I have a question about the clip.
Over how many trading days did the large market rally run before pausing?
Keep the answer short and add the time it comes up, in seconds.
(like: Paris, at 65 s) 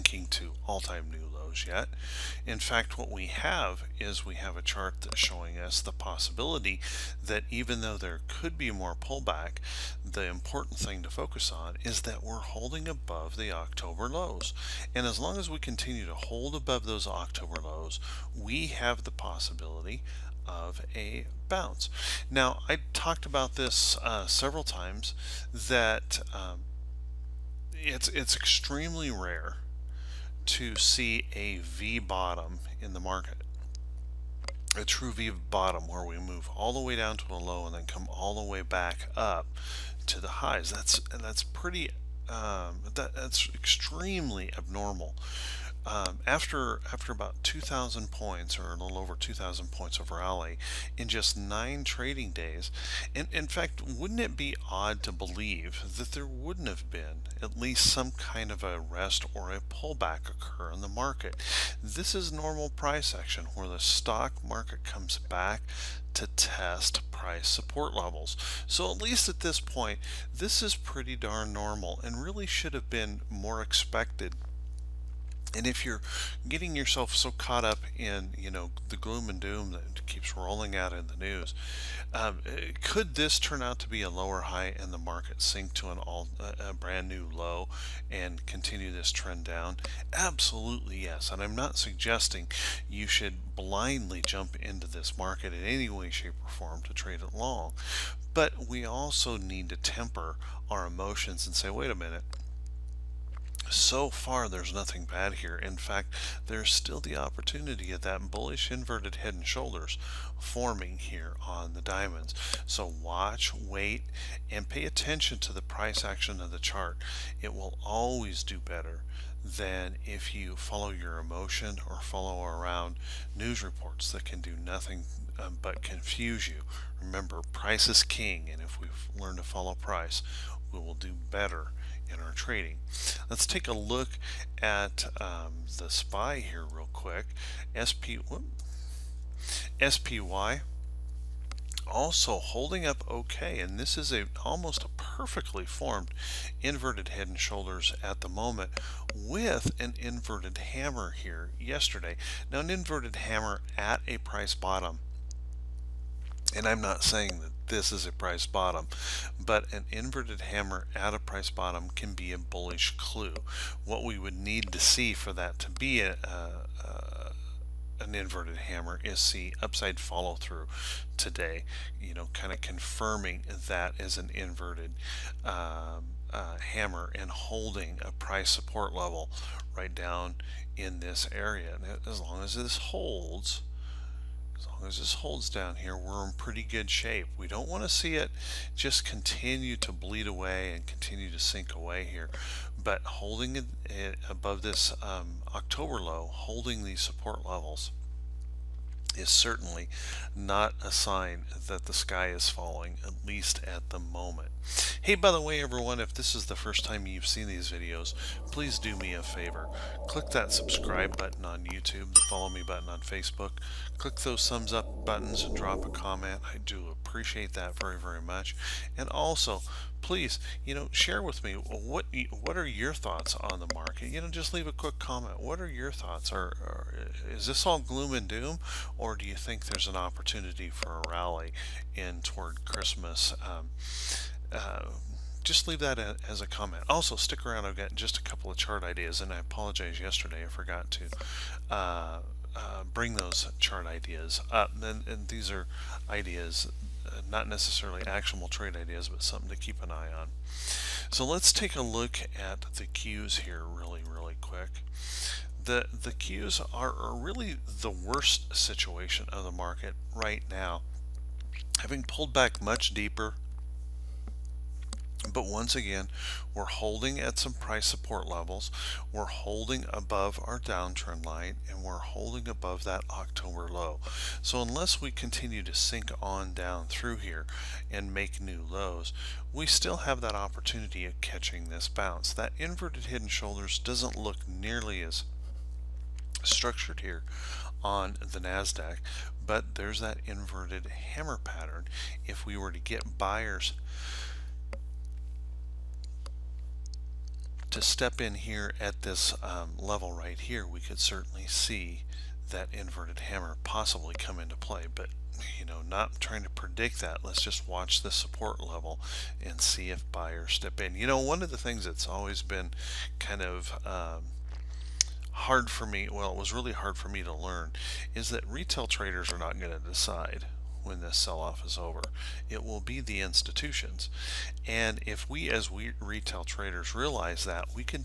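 9, at 51 s.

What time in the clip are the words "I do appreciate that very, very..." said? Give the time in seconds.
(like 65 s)
216 s.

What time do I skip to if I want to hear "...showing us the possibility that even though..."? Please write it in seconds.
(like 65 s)
5 s.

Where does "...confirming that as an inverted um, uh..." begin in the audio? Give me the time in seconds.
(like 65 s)
172 s.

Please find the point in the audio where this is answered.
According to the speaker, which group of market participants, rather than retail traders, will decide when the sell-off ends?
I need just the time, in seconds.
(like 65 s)
322 s.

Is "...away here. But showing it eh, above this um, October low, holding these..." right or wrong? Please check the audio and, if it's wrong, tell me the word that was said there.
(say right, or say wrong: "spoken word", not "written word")
wrong: "holding", not "showing".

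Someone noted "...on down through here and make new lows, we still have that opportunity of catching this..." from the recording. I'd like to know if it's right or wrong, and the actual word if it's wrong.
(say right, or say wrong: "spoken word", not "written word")
right.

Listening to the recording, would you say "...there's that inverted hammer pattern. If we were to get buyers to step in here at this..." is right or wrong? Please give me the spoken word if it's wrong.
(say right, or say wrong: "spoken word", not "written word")
right.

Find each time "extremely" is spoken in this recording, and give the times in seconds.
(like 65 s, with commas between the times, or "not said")
28 s, 43 s.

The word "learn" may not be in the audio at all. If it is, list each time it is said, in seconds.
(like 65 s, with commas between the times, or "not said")
129 s, 317 s.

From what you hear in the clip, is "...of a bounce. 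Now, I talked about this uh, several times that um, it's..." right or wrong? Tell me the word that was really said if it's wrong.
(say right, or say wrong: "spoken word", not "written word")
right.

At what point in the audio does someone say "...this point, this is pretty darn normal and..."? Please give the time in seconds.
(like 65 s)
69 s.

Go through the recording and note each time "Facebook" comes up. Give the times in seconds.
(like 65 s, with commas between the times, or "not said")
212 s.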